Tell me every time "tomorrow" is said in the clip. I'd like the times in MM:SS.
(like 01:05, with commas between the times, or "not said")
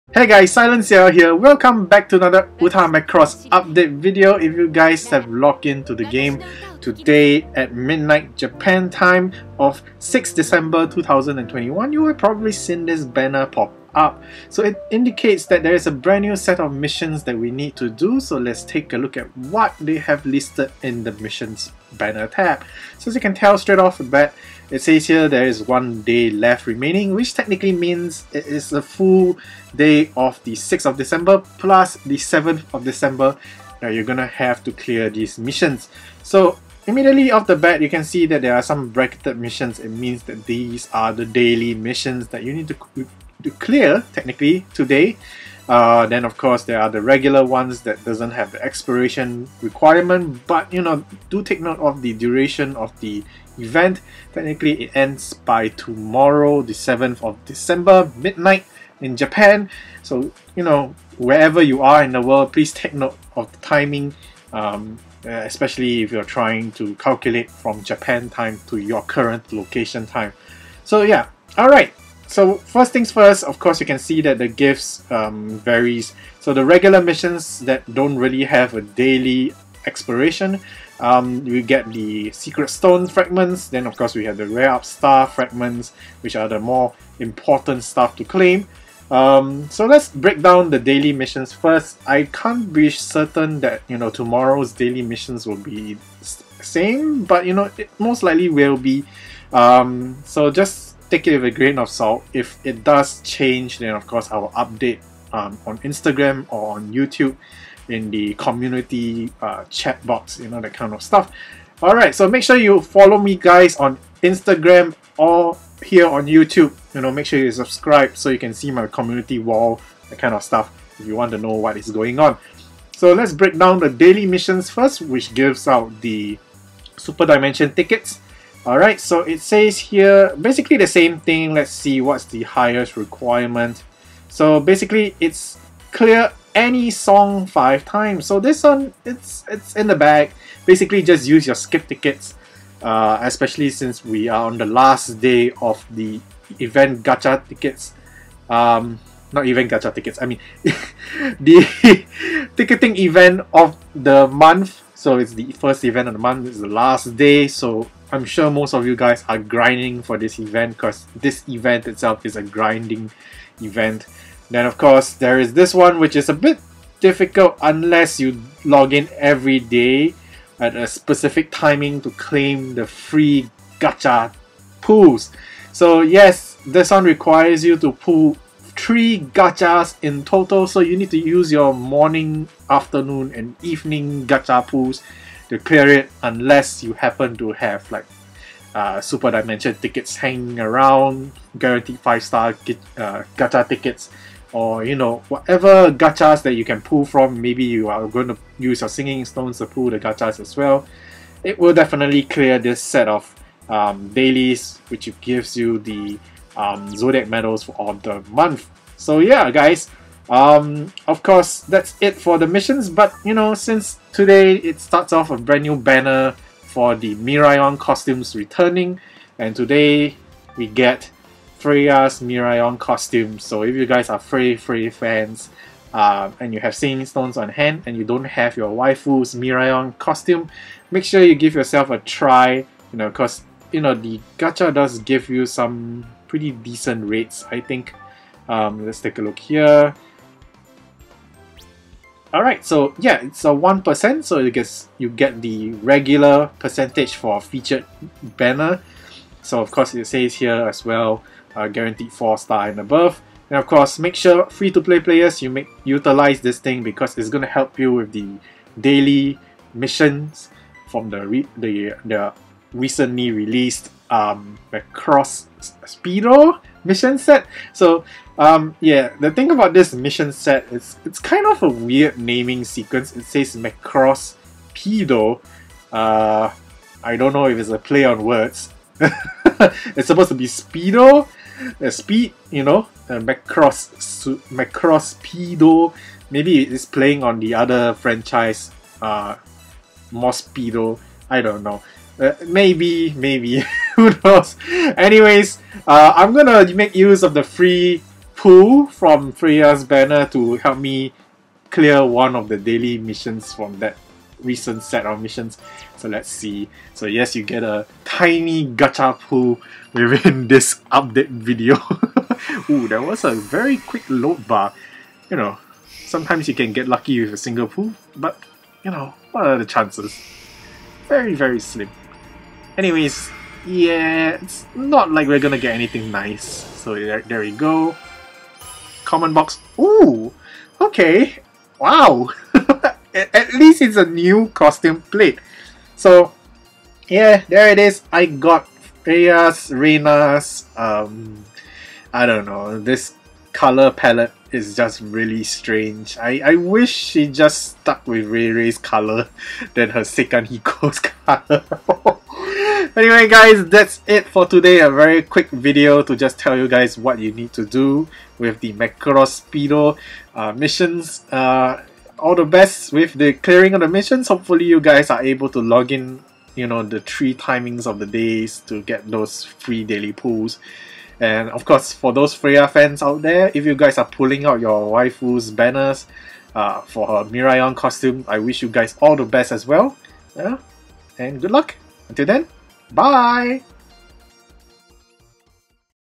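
00:55, 01:34.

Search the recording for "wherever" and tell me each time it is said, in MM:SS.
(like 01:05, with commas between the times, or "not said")
01:01.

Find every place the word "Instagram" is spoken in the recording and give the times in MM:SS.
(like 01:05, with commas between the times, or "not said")
01:45, 01:54.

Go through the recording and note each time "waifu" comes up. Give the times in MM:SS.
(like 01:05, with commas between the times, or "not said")
03:48, 06:14.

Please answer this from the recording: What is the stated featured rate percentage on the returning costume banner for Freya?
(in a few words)
1%.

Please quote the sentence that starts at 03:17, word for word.
Maybe you are going to use your singing stones to pull the gachas as well.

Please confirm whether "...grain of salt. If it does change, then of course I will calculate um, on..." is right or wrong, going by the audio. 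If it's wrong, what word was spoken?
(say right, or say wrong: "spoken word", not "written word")
wrong: "update", not "calculate".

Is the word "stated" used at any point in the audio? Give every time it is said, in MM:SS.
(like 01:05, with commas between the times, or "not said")
not said.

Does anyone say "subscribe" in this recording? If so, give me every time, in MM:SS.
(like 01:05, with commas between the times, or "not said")
01:57.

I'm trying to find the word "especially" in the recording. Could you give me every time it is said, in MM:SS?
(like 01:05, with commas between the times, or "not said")
01:05, 02:23.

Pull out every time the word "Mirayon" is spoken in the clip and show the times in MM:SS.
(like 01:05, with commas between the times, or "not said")
06:17.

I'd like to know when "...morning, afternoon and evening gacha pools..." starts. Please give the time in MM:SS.
03:01.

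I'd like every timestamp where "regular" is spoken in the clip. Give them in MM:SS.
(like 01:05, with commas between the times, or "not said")
00:47, 01:16, 04:05.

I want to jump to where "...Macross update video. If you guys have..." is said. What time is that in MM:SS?
00:02.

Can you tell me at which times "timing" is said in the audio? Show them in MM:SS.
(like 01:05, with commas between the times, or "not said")
01:03, 02:51, 06:07.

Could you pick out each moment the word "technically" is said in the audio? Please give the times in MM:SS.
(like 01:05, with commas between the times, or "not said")
00:27, 00:44, 00:54.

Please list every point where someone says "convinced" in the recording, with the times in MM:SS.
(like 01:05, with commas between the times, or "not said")
not said.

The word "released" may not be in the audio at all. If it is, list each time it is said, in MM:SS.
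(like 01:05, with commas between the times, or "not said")
04:23.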